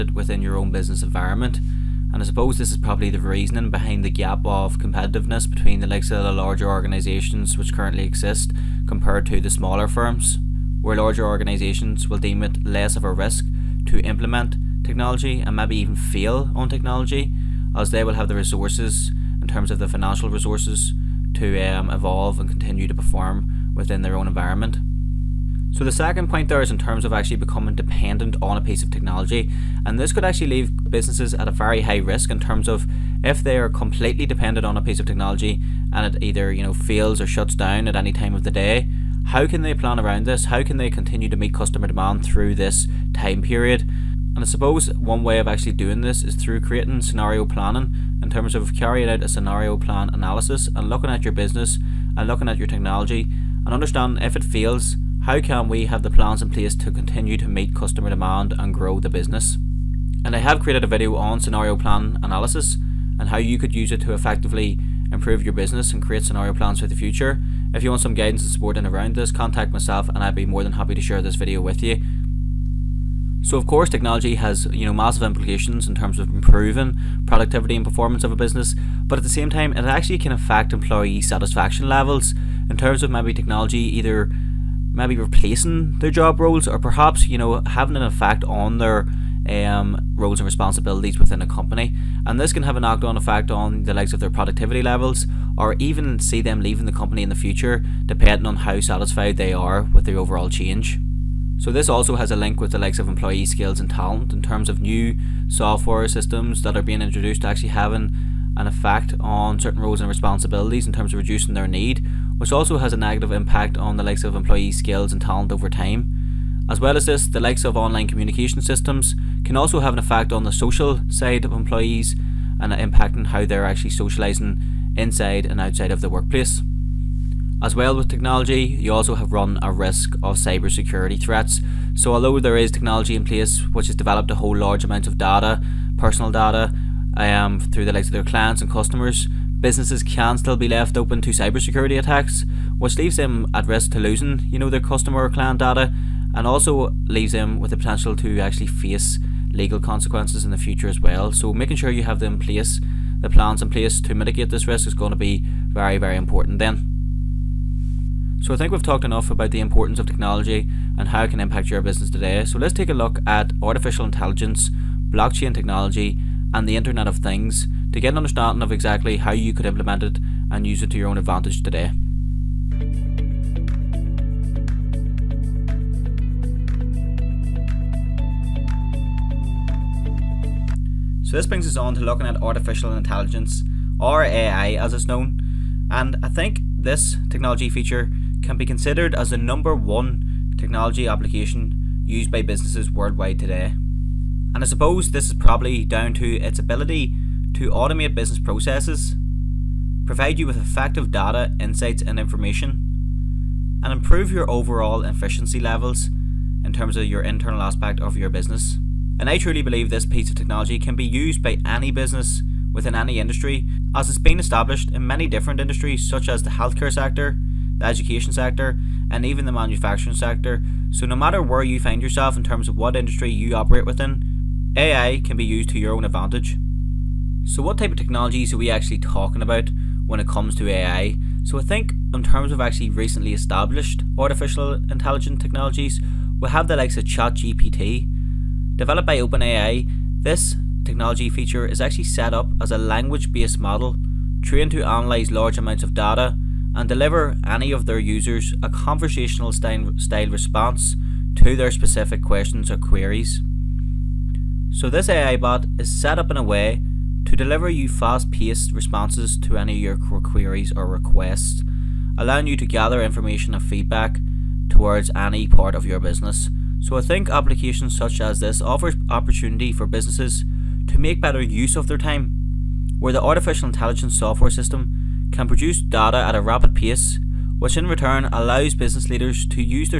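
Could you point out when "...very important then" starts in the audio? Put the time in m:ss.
2:35.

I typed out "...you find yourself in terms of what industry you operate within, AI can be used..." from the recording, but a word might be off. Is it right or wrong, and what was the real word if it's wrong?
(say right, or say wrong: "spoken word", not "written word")
right.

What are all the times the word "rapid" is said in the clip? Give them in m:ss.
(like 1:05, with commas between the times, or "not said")
4:36.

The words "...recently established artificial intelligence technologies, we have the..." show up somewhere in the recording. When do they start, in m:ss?
3:52.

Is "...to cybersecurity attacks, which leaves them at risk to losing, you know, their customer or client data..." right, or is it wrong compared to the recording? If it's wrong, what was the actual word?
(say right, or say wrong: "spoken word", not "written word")
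right.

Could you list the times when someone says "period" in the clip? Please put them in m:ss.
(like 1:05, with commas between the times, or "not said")
0:43.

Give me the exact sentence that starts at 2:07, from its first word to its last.
As well with technology, you also have run a risk of cybersecurity threats.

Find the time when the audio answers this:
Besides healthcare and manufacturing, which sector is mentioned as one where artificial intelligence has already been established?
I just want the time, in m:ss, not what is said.
3:37.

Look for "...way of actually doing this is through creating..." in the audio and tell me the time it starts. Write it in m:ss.
0:45.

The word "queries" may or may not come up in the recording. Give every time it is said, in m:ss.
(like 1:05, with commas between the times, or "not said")
4:12, 4:20.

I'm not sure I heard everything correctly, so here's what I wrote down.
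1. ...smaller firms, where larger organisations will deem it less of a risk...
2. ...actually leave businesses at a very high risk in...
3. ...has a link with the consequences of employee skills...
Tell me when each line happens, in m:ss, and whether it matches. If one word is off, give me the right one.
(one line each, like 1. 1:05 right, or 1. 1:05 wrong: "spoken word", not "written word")
1. 0:09 right
2. 0:30 right
3. 1:42 wrong: "likes", not "consequences".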